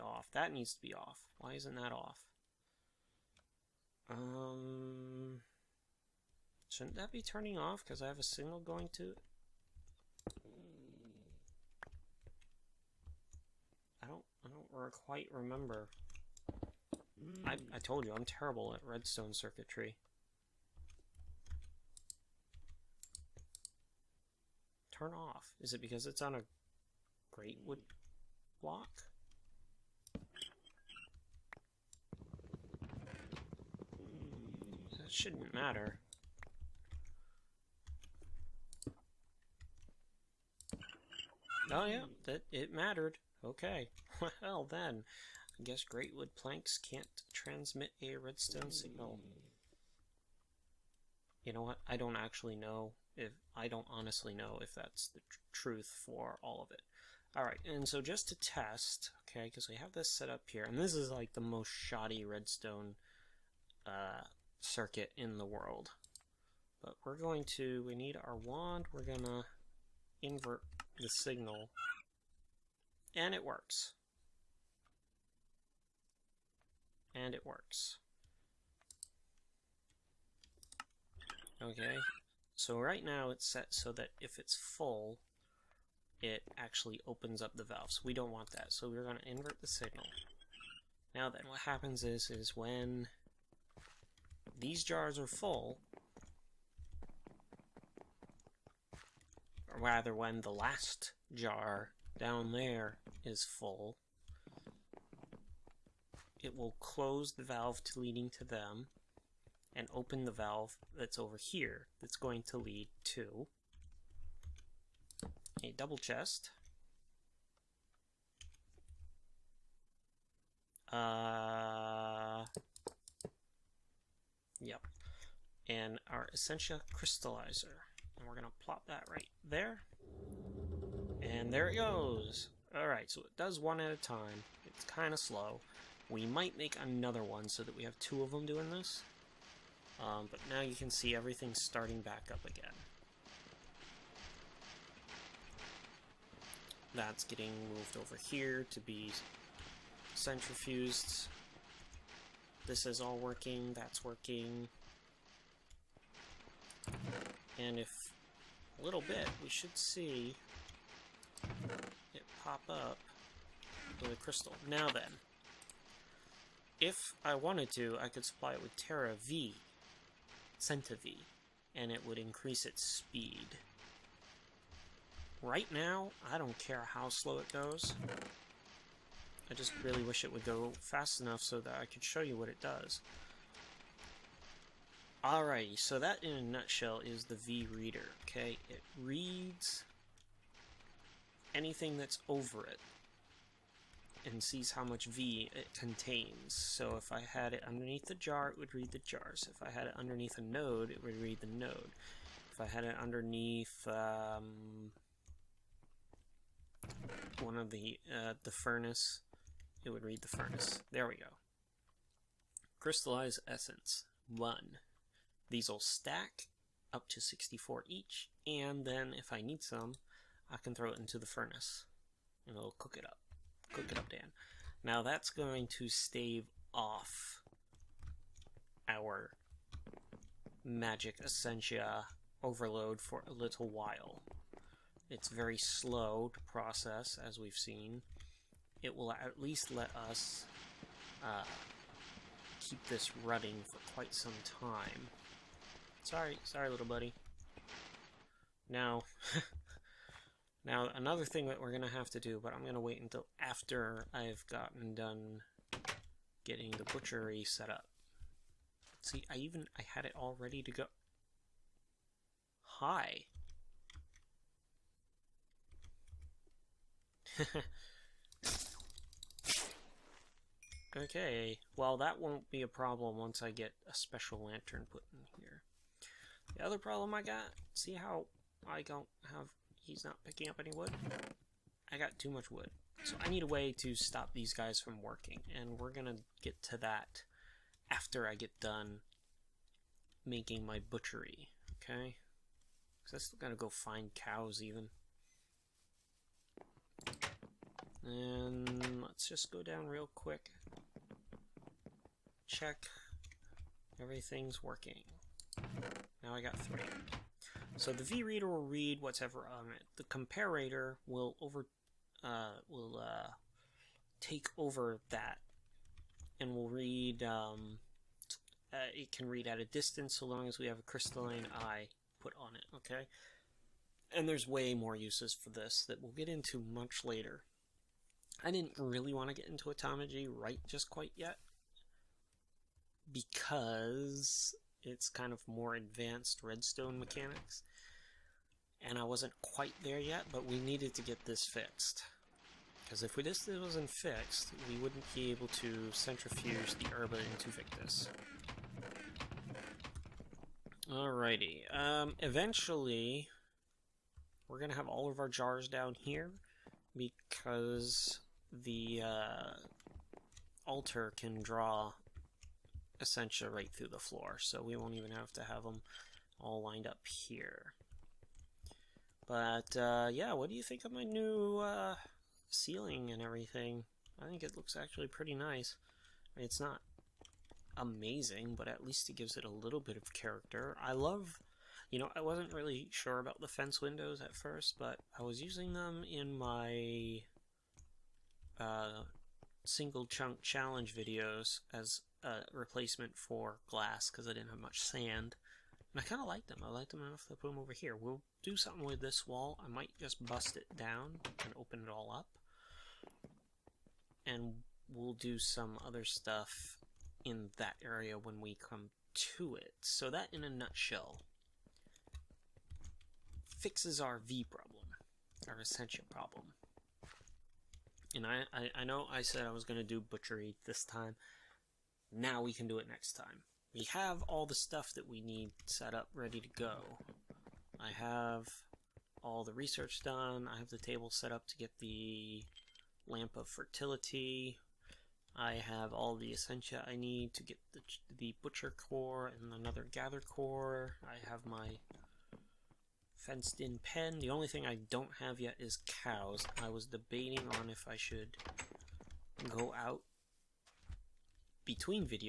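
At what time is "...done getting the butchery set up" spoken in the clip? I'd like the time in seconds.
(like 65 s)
254 s.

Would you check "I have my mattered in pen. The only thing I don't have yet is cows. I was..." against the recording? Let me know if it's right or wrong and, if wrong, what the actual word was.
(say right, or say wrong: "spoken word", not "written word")
wrong: "fenced", not "mattered".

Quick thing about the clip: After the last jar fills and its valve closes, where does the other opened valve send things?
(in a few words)
A double chest.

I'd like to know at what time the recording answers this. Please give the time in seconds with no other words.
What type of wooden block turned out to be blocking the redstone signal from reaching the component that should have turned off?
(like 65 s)
45 s.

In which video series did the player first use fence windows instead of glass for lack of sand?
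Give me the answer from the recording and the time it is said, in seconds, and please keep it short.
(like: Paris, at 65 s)
Single chunk challenge, at 389 s.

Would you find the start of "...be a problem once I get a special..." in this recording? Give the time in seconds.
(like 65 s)
272 s.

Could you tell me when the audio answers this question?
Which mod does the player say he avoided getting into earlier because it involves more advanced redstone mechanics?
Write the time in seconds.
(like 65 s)
329 s.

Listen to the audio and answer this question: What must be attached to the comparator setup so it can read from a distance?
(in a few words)
A crystalline eye.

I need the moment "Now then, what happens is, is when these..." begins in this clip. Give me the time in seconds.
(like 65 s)
91 s.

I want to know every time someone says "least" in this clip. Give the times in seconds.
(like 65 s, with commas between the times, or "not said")
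239 s, 378 s.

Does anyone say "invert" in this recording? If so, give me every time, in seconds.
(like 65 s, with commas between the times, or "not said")
70 s, 89 s.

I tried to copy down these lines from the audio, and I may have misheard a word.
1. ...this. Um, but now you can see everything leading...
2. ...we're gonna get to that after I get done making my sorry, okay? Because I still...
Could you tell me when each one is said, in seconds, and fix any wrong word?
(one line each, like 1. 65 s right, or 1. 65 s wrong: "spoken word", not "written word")
1. 138 s wrong: "starting", not "leading"
2. 285 s wrong: "butchery", not "sorry".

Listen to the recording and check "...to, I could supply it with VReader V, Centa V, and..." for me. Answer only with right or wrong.
wrong.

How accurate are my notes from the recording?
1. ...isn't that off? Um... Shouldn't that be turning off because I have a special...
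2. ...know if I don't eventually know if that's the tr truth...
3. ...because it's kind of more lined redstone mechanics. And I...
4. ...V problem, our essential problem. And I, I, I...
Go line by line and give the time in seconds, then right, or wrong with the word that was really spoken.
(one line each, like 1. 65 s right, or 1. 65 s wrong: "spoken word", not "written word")
1. 1 s wrong: "signal", not "special"
2. 52 s wrong: "honestly", not "eventually"
3. 333 s wrong: "advanced", not "lined"
4. 414 s right.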